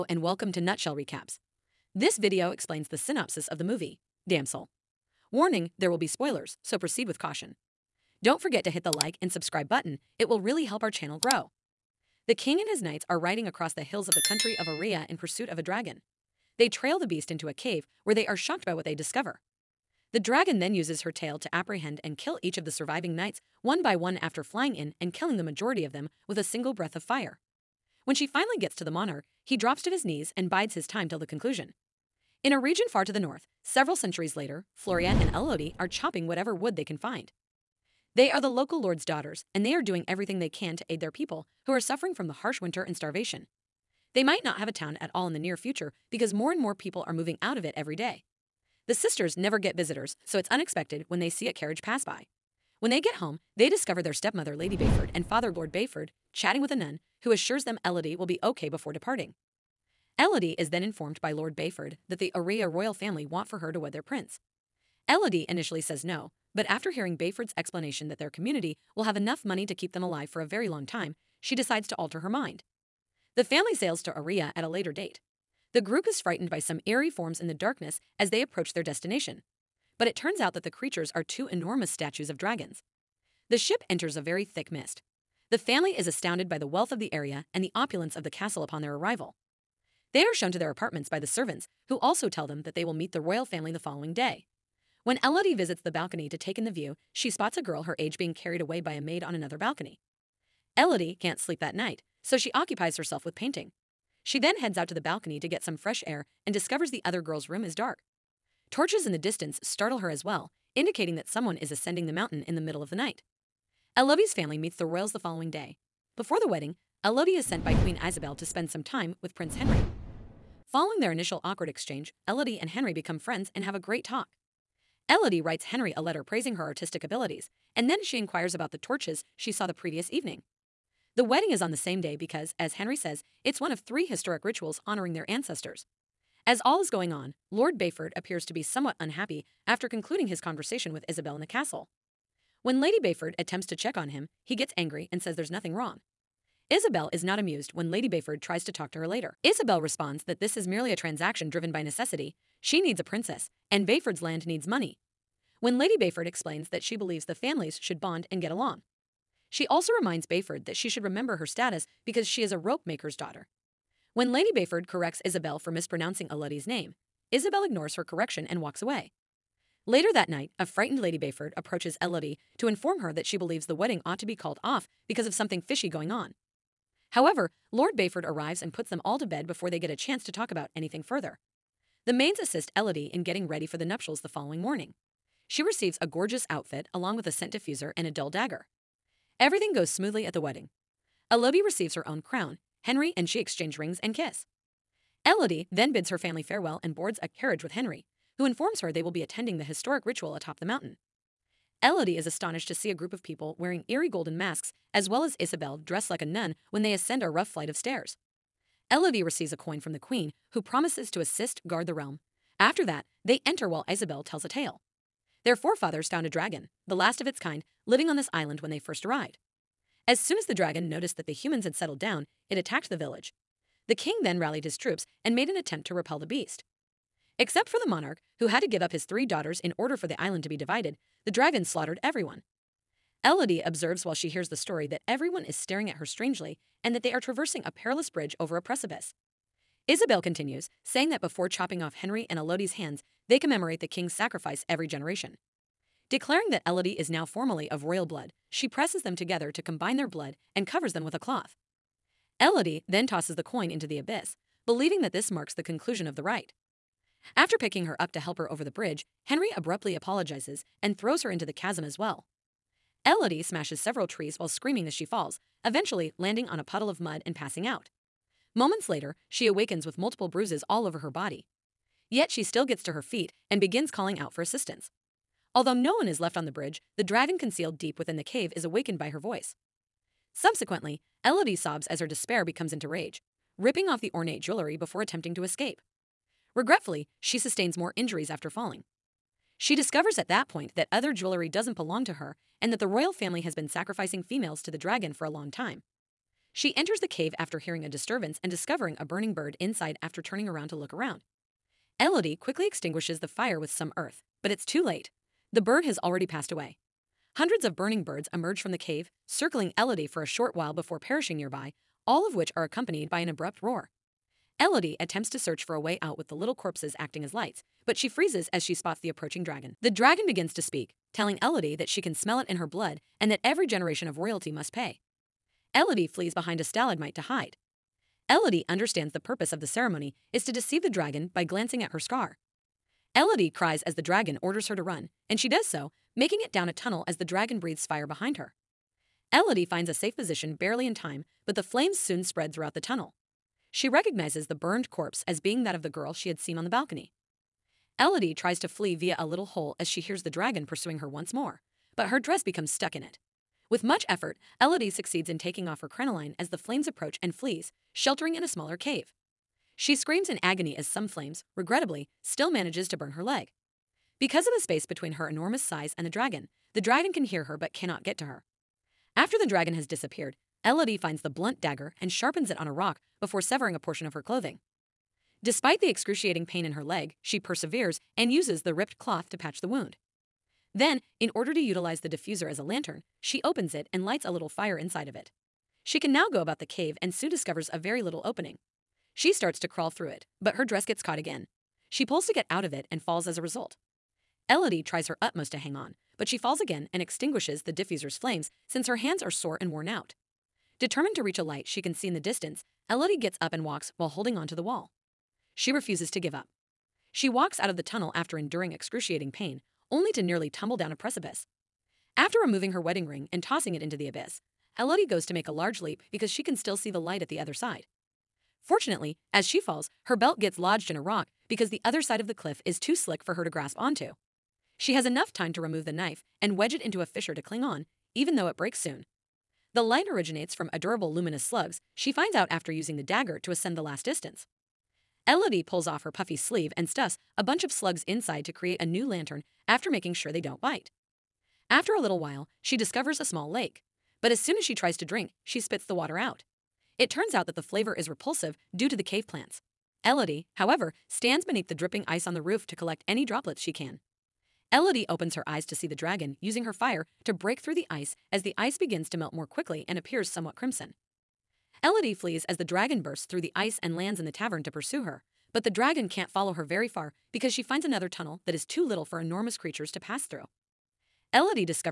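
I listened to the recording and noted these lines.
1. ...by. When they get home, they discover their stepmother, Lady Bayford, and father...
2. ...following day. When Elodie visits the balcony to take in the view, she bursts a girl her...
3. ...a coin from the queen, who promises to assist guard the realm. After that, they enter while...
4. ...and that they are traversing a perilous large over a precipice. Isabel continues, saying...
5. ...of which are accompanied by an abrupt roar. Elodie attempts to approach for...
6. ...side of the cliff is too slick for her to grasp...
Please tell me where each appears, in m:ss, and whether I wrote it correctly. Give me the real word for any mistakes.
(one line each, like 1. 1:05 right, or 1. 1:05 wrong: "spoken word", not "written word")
1. 0:52 right
2. 1:33 wrong: "spots", not "bursts"
3. 3:29 right
4. 3:56 wrong: "bridge", not "large"
5. 5:12 wrong: "search", not "approach"
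6. 7:02 right.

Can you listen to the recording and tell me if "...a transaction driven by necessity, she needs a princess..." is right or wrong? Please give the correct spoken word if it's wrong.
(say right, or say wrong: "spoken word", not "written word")
right.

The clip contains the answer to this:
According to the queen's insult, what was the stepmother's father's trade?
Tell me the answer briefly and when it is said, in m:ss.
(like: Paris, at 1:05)
rope maker, at 2:42.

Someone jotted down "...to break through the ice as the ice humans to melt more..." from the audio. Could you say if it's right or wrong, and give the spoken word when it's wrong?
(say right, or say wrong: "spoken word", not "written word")
wrong: "begins", not "humans".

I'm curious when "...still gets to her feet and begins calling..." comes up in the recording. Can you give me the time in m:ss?
4:32.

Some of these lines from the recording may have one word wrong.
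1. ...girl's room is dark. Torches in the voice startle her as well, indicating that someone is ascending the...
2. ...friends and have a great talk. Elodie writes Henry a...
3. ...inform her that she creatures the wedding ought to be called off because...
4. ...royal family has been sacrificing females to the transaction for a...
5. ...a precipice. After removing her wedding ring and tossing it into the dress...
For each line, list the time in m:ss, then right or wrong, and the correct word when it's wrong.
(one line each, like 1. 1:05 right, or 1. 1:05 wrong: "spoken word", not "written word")
1. 1:47 wrong: "distance", not "voice"
2. 2:03 right
3. 2:52 wrong: "believes", not "creatures"
4. 4:52 wrong: "dragon", not "transaction"
5. 6:50 wrong: "abyss", not "dress".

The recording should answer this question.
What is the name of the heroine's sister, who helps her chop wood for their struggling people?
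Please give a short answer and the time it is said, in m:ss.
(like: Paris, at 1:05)
Floria, at 0:34.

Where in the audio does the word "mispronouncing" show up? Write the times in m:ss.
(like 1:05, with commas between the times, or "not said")
2:45.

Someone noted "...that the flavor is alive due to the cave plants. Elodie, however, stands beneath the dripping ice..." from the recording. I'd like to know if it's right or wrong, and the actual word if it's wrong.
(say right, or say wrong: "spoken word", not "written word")
wrong: "repulsive", not "alive".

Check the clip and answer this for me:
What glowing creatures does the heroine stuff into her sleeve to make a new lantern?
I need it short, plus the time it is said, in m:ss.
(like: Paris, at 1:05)
luminous slugs, at 7:11.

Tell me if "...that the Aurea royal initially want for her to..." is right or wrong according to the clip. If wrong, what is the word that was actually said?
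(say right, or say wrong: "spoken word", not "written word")
wrong: "family", not "initially".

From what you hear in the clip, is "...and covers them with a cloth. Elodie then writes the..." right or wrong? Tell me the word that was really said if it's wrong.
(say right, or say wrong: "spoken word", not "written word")
wrong: "tosses", not "writes".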